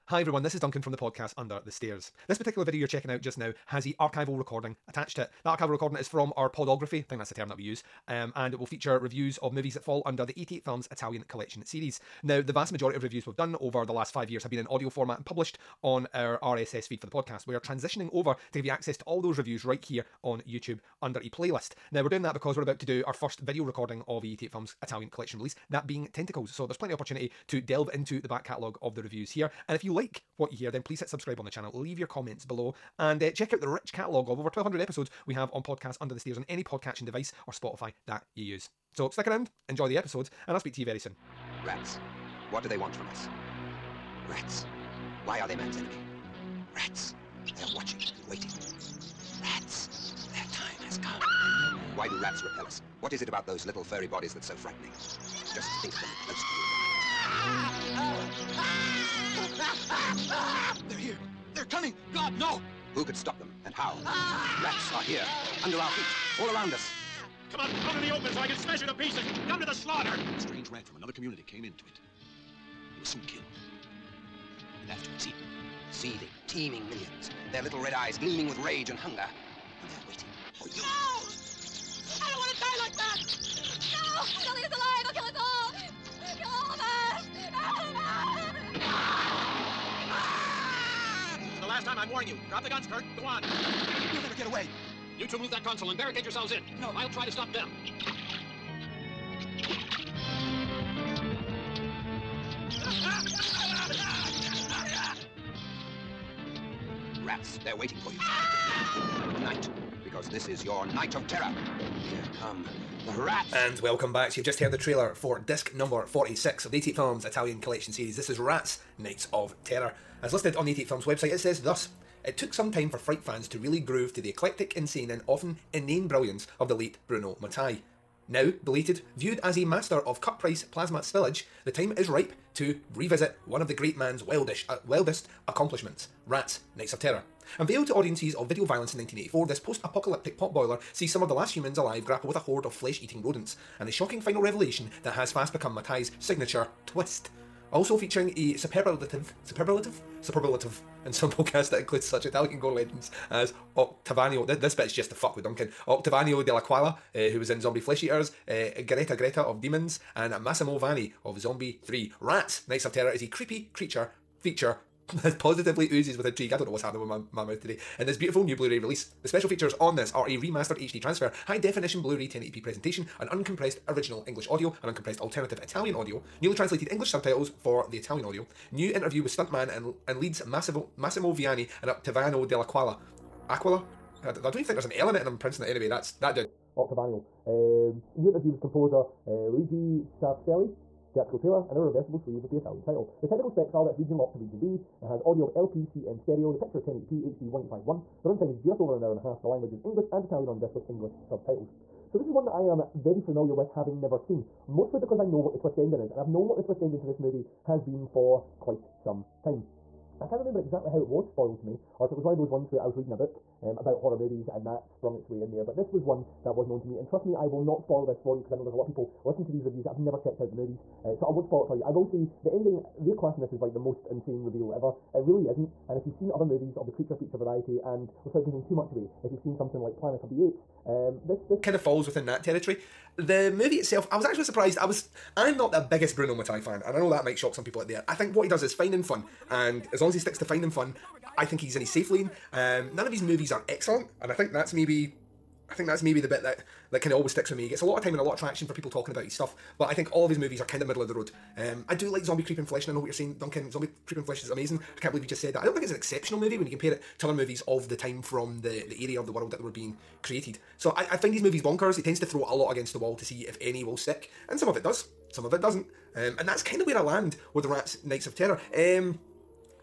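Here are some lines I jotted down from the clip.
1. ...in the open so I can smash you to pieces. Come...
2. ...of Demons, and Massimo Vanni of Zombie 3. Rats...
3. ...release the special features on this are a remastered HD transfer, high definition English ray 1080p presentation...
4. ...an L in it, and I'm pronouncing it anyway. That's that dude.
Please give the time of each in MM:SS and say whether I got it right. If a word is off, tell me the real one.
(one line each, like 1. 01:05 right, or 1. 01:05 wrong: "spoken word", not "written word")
1. 01:08 right
2. 02:39 right
3. 02:48 wrong: "Blu", not "English"
4. 03:04 right.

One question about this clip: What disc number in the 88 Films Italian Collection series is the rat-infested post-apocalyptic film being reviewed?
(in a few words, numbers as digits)
46.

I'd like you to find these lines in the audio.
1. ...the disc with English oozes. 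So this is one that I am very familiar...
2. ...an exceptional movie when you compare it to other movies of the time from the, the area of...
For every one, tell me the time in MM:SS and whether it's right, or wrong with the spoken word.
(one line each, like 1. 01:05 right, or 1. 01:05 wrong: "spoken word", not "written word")
1. 03:20 wrong: "subtitles", not "oozes"
2. 04:15 right.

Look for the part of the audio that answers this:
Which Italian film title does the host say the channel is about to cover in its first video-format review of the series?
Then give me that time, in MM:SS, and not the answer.
00:26.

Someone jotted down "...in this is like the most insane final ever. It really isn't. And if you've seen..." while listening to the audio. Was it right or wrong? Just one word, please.
wrong.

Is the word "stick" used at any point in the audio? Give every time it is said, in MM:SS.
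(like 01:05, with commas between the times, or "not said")
00:39, 04:00, 04:07, 04:23.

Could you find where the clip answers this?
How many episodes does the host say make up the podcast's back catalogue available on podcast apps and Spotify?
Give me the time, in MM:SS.
00:34.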